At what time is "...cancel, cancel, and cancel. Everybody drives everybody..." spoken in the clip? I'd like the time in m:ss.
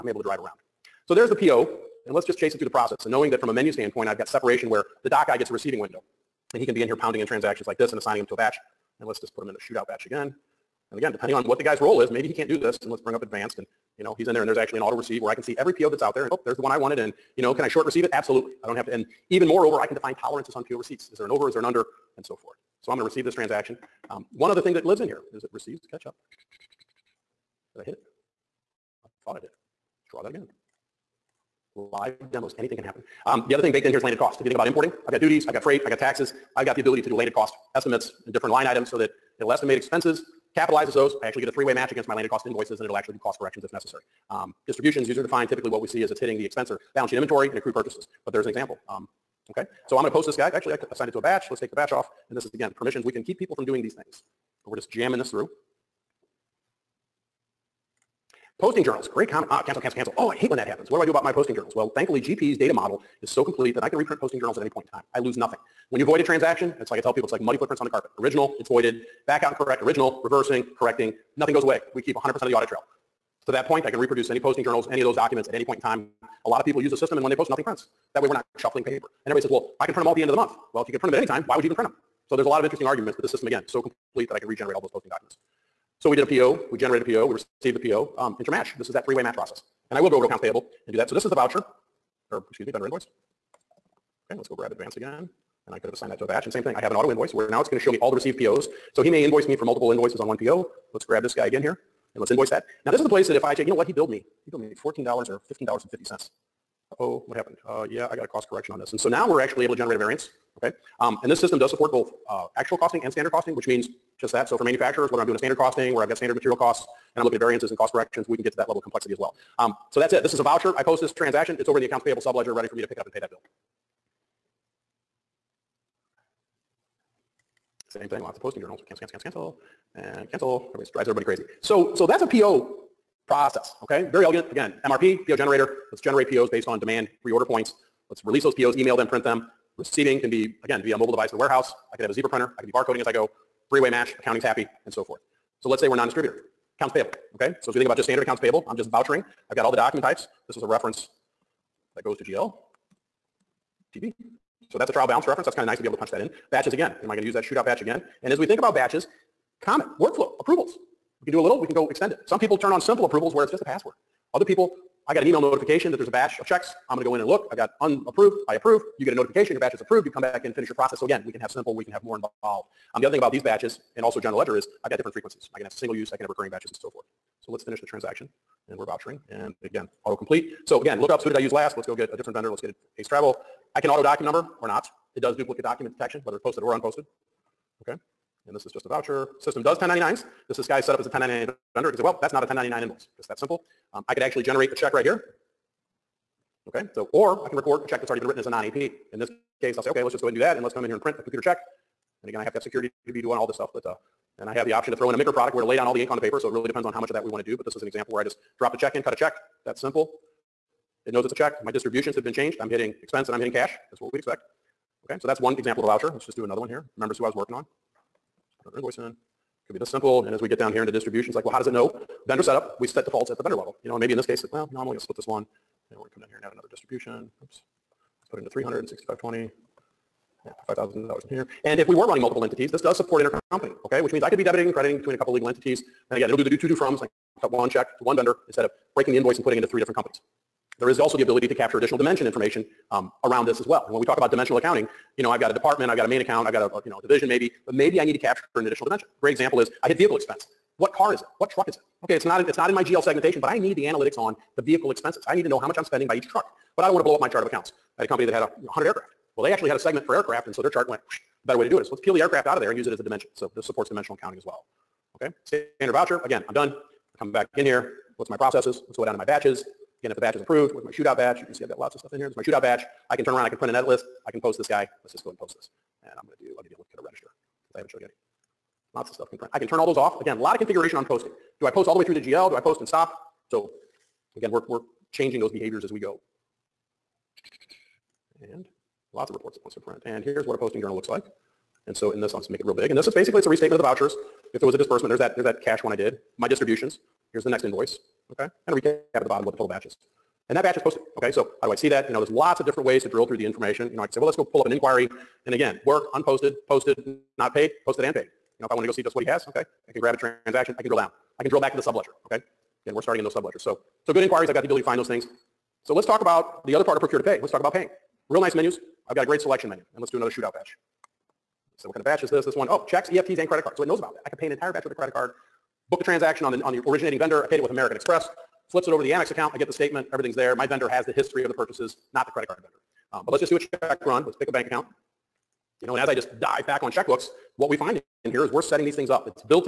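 2:09.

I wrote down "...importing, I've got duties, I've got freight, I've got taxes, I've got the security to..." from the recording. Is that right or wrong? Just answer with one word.
wrong.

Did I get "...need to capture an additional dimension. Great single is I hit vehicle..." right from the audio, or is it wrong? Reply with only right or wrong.
wrong.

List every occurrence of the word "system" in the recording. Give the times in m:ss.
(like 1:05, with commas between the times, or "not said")
1:16, 1:23, 1:51, 3:09.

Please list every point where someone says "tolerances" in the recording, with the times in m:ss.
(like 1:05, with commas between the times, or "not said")
0:20.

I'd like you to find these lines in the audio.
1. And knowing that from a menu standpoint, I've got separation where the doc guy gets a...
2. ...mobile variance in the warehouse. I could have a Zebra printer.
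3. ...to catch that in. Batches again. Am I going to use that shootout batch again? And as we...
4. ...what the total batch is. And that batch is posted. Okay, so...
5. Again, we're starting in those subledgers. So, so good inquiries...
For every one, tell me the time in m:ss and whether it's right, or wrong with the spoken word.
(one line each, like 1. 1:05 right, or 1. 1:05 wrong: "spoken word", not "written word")
1. 0:03 right
2. 2:20 wrong: "device", not "variance"
3. 2:35 wrong: "punch", not "catch"
4. 4:59 right
5. 5:12 right.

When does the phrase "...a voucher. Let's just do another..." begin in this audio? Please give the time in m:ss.
3:35.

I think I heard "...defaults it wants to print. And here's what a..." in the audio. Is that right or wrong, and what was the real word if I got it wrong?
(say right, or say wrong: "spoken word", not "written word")
wrong: "reports", not "defaults".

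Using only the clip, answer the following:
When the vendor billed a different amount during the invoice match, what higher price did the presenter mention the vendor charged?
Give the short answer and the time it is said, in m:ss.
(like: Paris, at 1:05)
$15.50, at 1:45.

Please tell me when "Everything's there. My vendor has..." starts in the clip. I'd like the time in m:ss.
5:30.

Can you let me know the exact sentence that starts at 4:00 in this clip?
There is also the ability to capture additional dimension information um, around this as well.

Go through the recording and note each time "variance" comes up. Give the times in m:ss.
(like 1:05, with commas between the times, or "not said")
1:49, 1:57.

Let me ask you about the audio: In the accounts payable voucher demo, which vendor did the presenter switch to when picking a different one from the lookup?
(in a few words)
Ace Travel.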